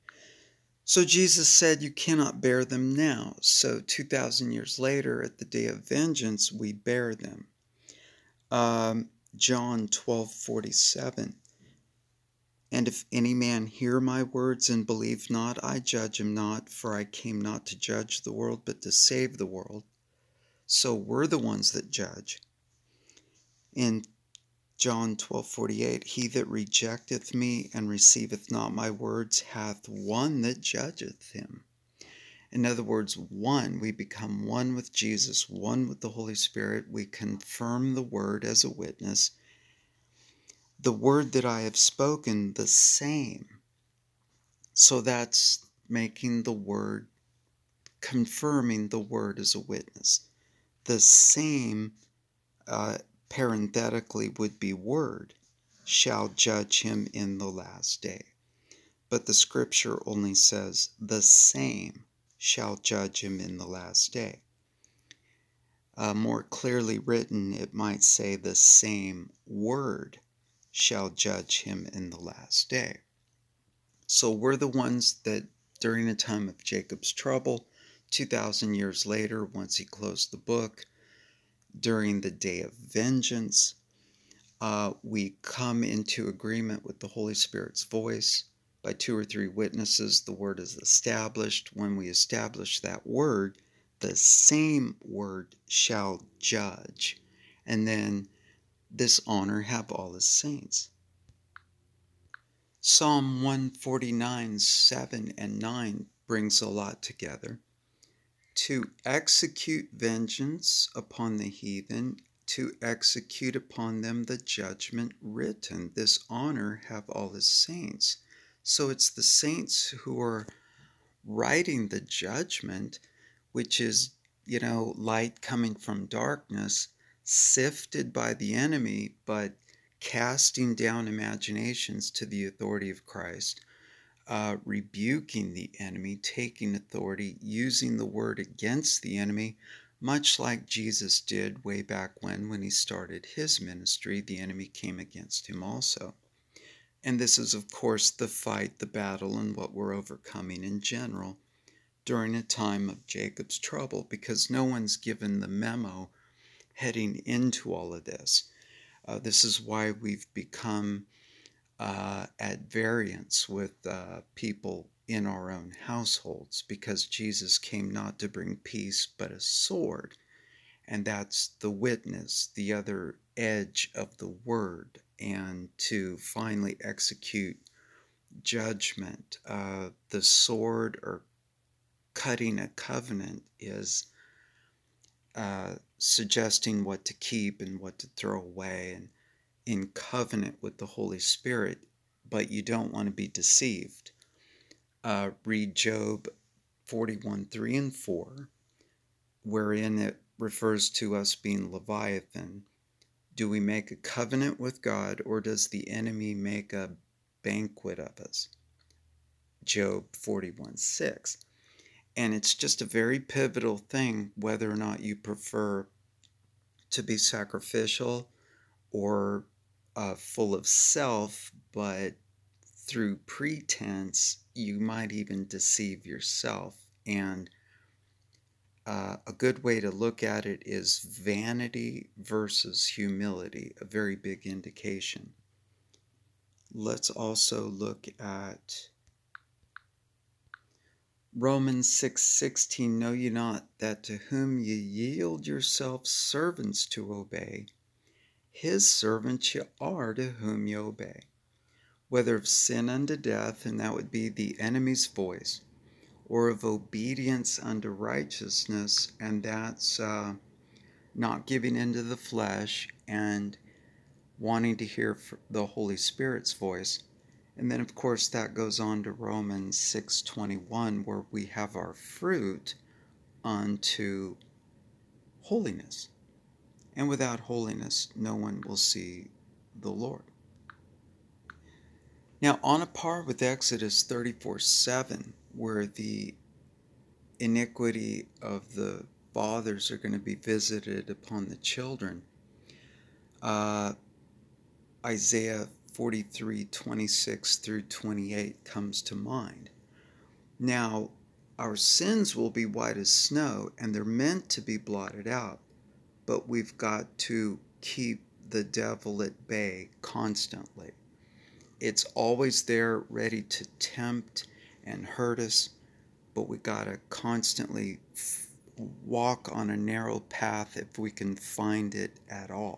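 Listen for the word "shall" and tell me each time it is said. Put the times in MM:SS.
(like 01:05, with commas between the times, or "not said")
00:55, 01:02, 01:10, 01:35.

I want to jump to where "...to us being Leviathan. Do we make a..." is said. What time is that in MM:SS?
03:20.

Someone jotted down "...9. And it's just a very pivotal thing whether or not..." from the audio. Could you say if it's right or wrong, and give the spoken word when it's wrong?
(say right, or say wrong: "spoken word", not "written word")
wrong: "6", not "9".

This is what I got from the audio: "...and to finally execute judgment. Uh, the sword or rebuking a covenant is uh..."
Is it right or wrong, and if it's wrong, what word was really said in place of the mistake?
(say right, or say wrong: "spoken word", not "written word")
wrong: "cutting", not "rebuking".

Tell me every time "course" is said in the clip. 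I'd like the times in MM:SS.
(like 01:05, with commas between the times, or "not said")
02:27, 04:27.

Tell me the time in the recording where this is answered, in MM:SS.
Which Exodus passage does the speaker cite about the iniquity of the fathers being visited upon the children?
04:43.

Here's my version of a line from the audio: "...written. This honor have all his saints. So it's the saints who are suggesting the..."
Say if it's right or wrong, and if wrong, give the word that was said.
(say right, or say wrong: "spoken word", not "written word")
wrong: "writing", not "suggesting".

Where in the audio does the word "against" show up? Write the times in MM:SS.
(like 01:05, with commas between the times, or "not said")
02:18, 02:24.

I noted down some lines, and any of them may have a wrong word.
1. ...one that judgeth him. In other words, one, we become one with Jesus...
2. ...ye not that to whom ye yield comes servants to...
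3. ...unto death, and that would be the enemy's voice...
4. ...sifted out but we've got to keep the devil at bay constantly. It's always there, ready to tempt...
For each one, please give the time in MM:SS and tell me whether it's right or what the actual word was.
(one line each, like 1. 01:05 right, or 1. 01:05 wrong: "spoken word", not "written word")
1. 00:29 right
2. 04:03 wrong: "yourselves", not "comes"
3. 04:12 right
4. 05:04 wrong: "blotted", not "sifted".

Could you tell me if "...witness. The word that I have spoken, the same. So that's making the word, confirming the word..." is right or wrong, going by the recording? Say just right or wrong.
right.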